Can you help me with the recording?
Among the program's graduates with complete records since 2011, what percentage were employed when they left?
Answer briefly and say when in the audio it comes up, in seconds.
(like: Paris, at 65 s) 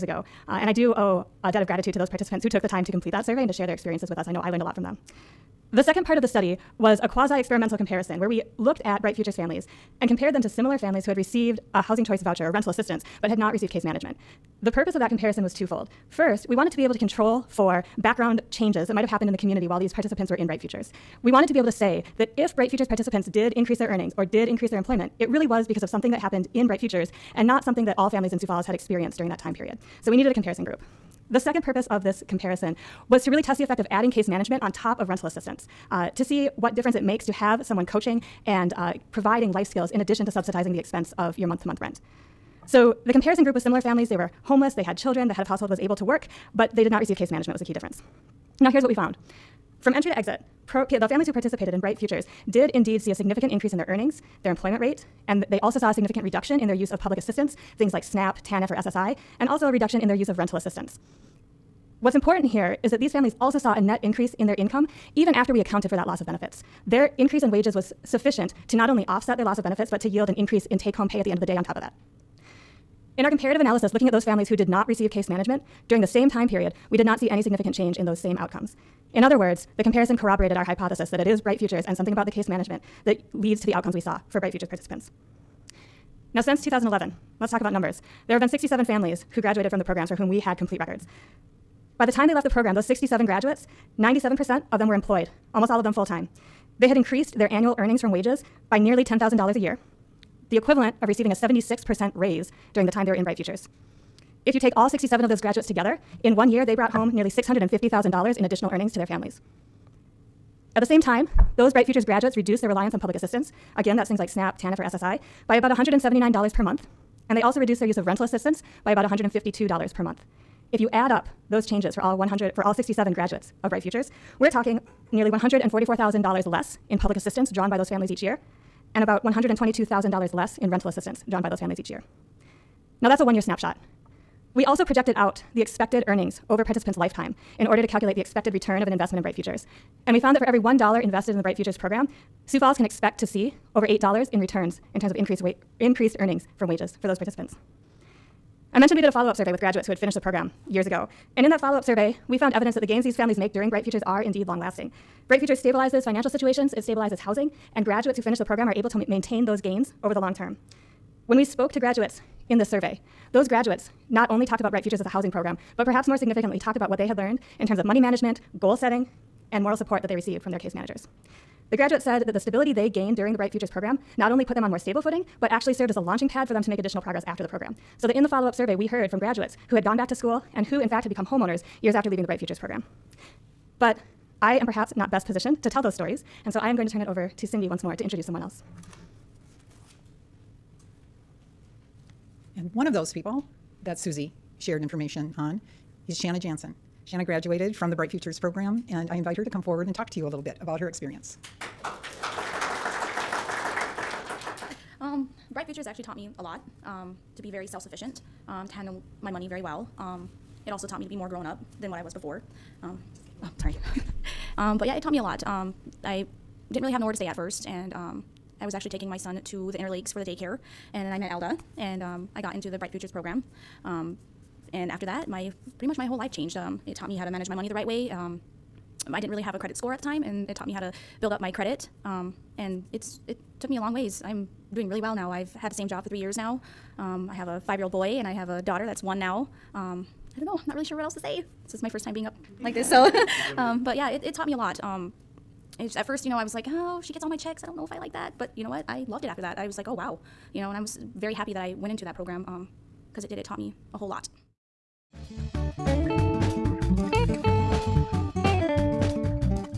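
97%, at 93 s.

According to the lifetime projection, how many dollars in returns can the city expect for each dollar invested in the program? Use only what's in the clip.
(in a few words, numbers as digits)
over $8.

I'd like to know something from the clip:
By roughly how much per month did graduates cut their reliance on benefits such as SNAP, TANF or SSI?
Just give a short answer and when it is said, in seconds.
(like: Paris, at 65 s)
$179, at 115 s.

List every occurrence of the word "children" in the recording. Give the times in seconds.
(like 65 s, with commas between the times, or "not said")
44 s.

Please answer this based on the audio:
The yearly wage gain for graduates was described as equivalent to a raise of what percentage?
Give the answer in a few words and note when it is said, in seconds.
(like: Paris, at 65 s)
76%, at 101 s.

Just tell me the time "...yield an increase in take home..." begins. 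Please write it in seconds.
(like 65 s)
70 s.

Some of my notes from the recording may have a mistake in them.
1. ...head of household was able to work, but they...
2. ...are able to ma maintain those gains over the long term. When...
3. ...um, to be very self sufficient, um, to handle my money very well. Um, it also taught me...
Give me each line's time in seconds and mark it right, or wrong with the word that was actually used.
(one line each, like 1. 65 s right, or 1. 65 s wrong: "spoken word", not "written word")
1. 45 s right
2. 158 s right
3. 206 s right.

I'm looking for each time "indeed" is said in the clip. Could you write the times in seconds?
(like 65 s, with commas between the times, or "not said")
52 s, 154 s.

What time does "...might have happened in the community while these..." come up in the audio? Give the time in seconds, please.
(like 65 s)
18 s.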